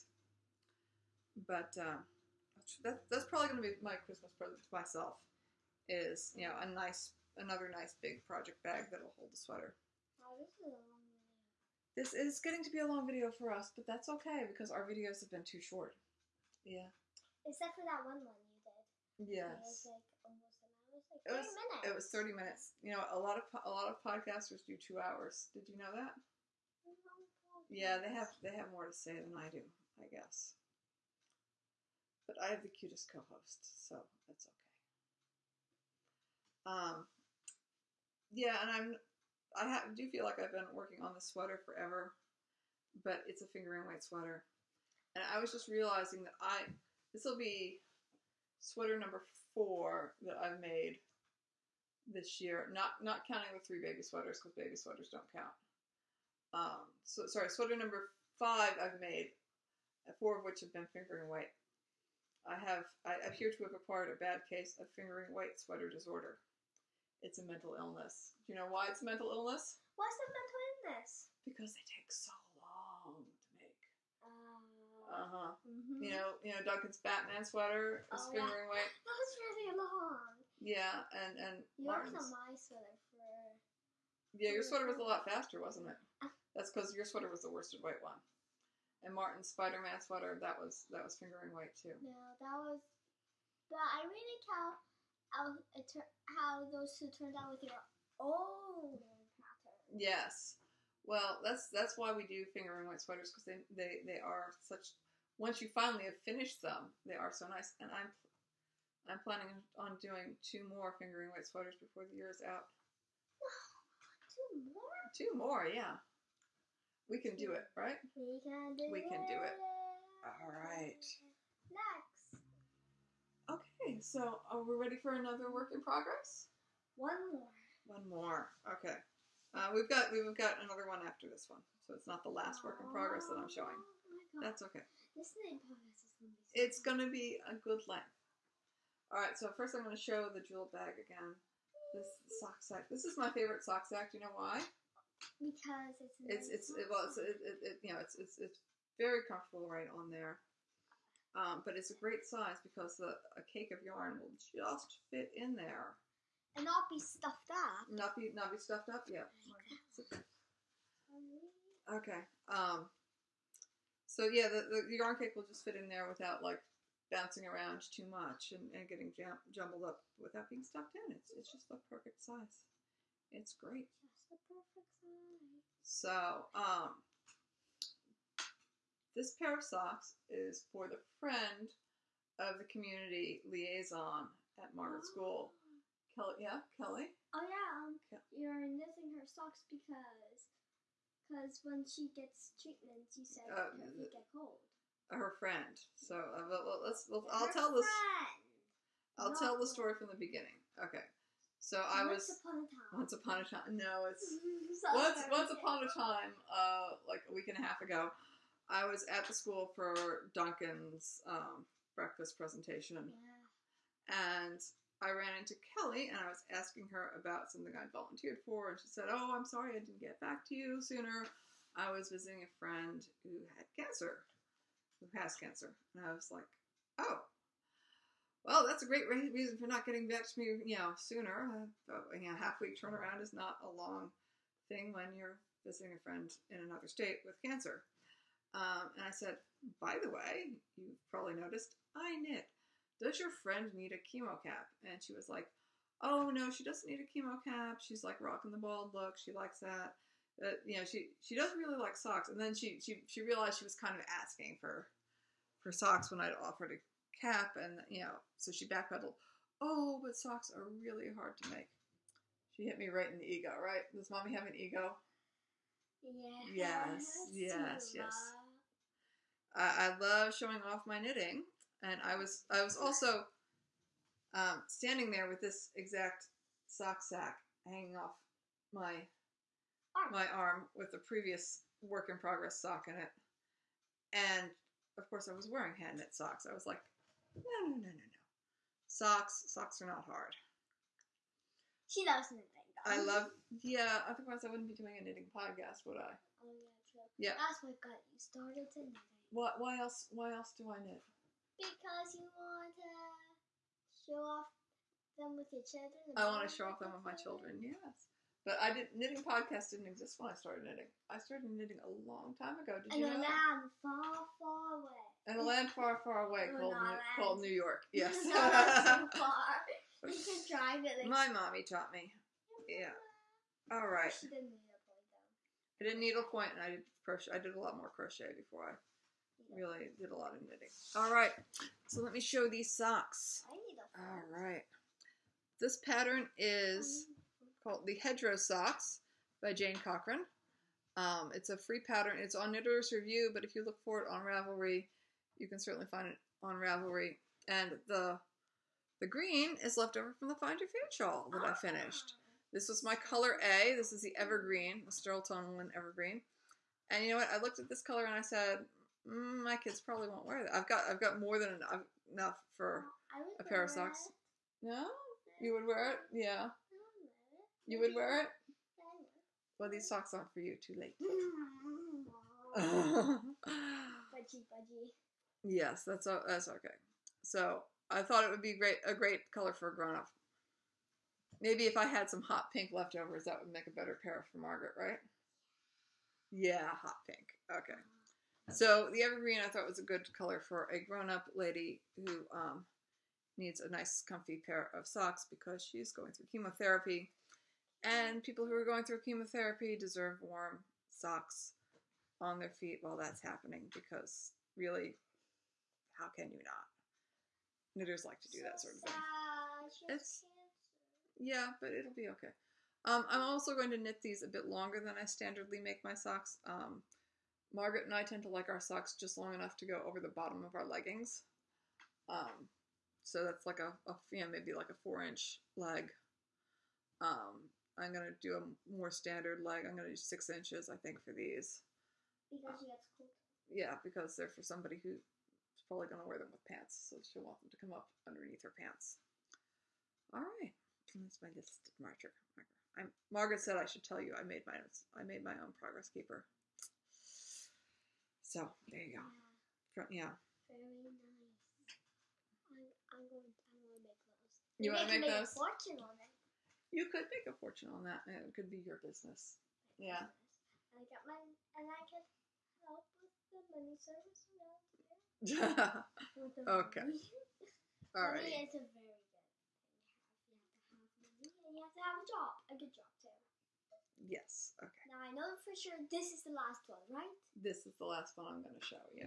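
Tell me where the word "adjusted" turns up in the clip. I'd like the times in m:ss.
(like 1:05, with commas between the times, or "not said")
not said.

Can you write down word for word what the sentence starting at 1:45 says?
Once you finally have finished them, they are so nice.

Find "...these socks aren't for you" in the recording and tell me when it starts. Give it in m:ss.
6:09.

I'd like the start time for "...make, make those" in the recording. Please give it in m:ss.
7:34.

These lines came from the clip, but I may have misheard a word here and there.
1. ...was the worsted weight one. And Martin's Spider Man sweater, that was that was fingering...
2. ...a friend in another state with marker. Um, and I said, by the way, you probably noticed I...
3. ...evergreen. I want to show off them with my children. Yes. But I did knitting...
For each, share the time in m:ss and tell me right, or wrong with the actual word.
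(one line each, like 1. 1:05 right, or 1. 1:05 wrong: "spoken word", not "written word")
1. 1:27 right
2. 3:55 wrong: "cancer", not "marker"
3. 5:05 wrong: "children", not "evergreen".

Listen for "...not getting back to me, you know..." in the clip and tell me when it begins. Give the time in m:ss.
3:49.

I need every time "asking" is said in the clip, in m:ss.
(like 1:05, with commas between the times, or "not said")
3:36, 4:14.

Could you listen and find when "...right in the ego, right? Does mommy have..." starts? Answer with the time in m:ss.
4:22.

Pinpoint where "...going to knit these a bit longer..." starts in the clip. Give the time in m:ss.
6:53.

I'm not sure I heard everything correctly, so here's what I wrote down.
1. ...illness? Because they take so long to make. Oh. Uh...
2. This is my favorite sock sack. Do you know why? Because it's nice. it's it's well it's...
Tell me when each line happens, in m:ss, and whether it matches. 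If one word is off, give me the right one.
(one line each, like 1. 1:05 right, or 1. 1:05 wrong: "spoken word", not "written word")
1. 1:10 right
2. 2:22 right.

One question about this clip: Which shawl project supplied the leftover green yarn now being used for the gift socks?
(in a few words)
Find Your Fade.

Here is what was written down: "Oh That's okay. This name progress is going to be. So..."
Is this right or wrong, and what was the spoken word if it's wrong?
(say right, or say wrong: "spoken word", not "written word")
right.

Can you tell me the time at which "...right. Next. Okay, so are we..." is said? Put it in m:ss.
2:00.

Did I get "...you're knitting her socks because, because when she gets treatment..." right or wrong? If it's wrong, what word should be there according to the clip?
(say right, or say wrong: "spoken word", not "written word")
right.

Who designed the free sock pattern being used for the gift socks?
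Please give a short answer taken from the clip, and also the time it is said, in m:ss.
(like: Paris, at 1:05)
Jane Cochran, at 5:39.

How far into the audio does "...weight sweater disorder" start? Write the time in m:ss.
1:05.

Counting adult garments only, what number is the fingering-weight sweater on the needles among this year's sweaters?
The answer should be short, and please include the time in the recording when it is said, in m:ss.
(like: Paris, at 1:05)
5, at 0:57.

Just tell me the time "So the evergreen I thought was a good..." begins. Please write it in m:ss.
6:28.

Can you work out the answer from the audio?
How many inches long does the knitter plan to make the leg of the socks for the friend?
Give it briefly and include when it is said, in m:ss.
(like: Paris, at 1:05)
6, at 7:09.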